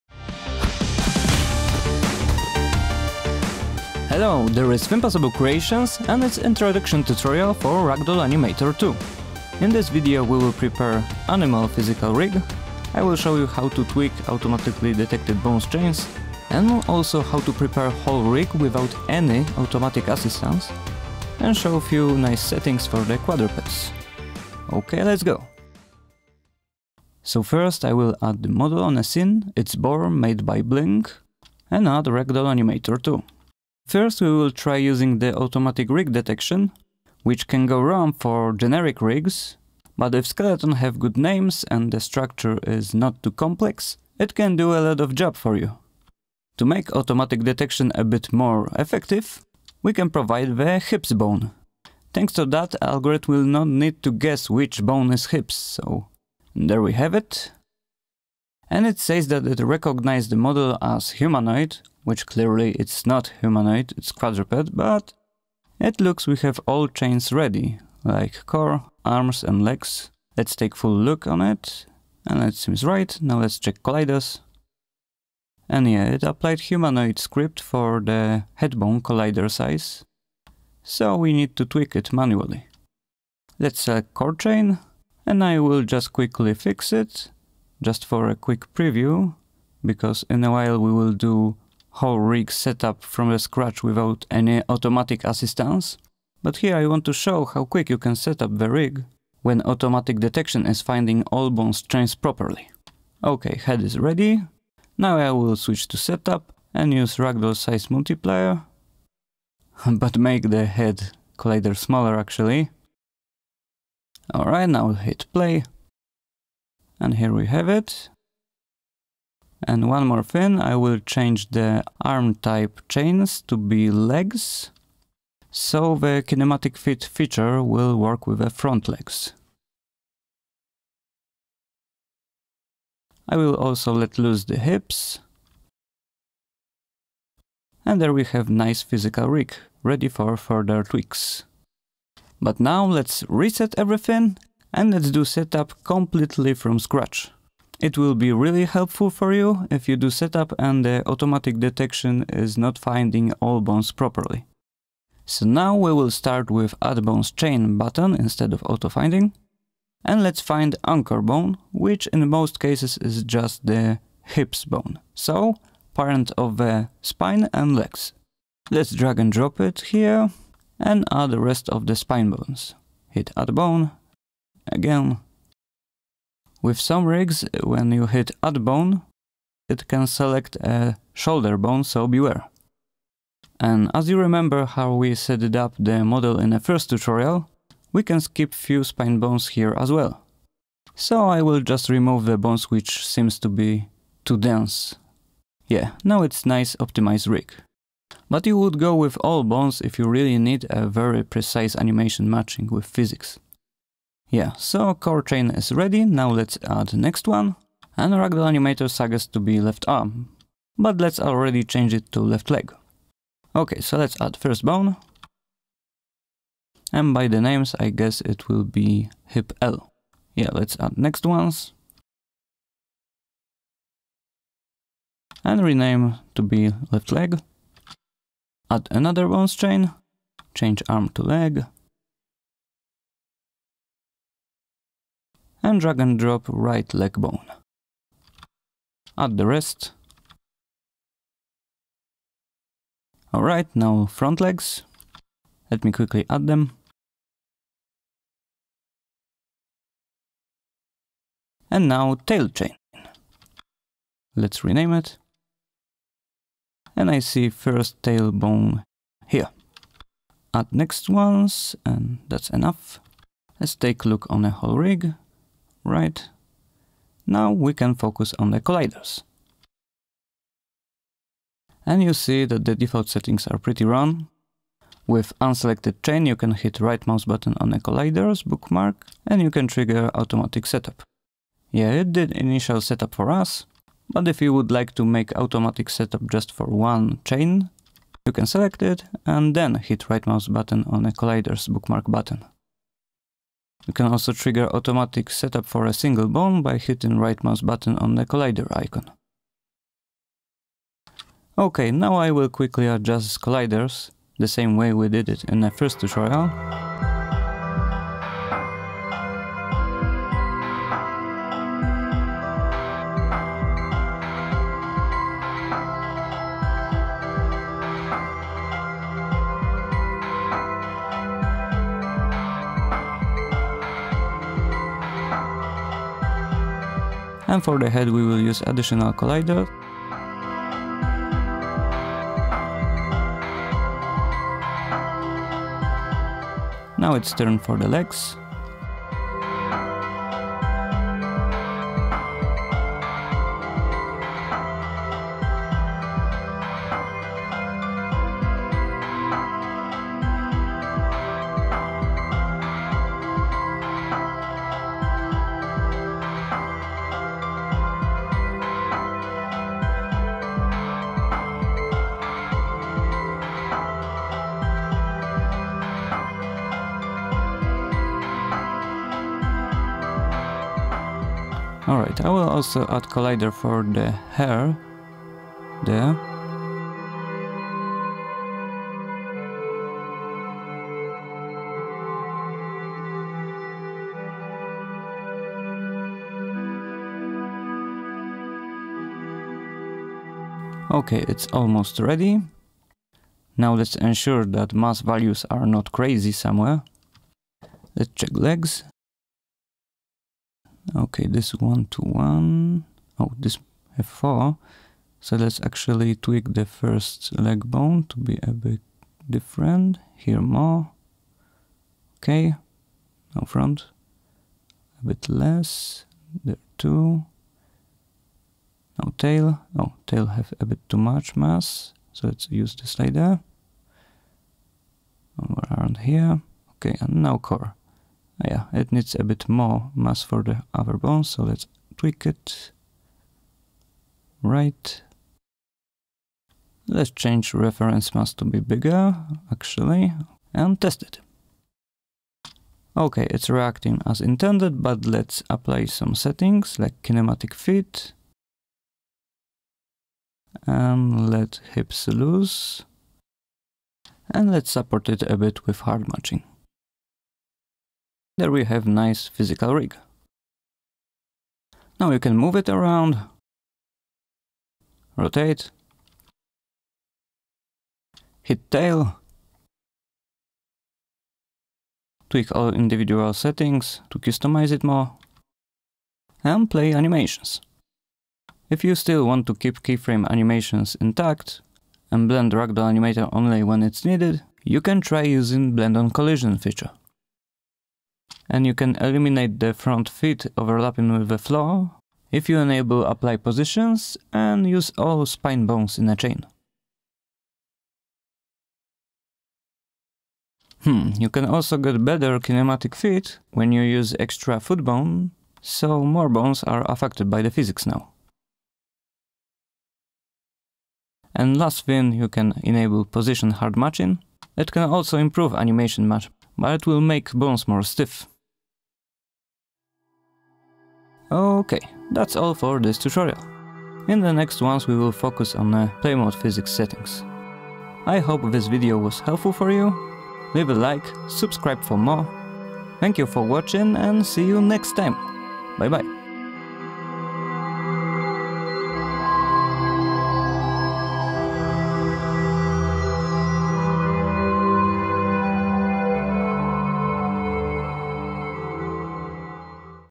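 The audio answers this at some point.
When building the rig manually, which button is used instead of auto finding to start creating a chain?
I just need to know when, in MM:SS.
02:36.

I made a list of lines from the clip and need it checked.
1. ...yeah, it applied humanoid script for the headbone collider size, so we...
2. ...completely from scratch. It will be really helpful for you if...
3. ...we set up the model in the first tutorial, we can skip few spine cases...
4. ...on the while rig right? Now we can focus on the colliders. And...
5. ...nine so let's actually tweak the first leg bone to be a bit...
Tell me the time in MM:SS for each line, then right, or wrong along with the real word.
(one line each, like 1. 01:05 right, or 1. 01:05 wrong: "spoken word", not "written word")
1. 01:15 right
2. 02:25 right
3. 03:04 wrong: "bones", not "cases"
4. 04:24 wrong: "whole", not "while"
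5. 06:44 wrong: "four", not "nine".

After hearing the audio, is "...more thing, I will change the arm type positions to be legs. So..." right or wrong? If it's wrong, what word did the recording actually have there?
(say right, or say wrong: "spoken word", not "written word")
wrong: "chains", not "positions".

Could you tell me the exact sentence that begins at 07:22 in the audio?
Okay, it's reacting as intended, but let's apply some settings like kinematic fit.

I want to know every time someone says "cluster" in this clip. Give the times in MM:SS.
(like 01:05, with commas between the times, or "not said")
not said.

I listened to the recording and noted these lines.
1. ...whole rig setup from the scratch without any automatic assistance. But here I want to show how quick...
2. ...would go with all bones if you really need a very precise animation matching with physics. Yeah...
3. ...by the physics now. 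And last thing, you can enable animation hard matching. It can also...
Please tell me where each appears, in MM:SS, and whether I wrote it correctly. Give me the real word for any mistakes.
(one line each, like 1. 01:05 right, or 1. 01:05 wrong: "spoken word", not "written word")
1. 01:31 right
2. 03:18 right
3. 08:27 wrong: "position", not "animation".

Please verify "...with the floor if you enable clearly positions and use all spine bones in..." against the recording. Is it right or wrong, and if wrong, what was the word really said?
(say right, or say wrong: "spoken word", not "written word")
wrong: "apply", not "clearly".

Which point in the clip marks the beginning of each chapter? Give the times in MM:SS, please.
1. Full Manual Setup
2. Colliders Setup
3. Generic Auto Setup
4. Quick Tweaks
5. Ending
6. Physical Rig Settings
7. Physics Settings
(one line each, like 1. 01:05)
1. 02:22
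2. 04:28
3. 00:25
4. 01:20
5. 08:42
6. 07:21
7. 06:32.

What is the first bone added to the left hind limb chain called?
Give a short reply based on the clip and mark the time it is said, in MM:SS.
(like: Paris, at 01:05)
hip L, at 03:39.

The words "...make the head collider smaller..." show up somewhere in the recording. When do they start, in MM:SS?
01:50.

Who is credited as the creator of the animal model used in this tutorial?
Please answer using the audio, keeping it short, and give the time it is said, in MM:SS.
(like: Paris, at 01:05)
Blink, at 00:30.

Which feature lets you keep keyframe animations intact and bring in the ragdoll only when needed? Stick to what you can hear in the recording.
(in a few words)
Blend on collision.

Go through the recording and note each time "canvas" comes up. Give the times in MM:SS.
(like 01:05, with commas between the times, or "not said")
not said.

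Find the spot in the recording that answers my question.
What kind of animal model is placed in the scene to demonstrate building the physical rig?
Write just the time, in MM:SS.
00:29.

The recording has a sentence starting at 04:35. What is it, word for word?
With unselected chain you can hit right mouse button on the colliders bookmark and you can trigger automatic setup.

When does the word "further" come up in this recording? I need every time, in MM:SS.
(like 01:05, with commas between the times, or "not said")
02:20.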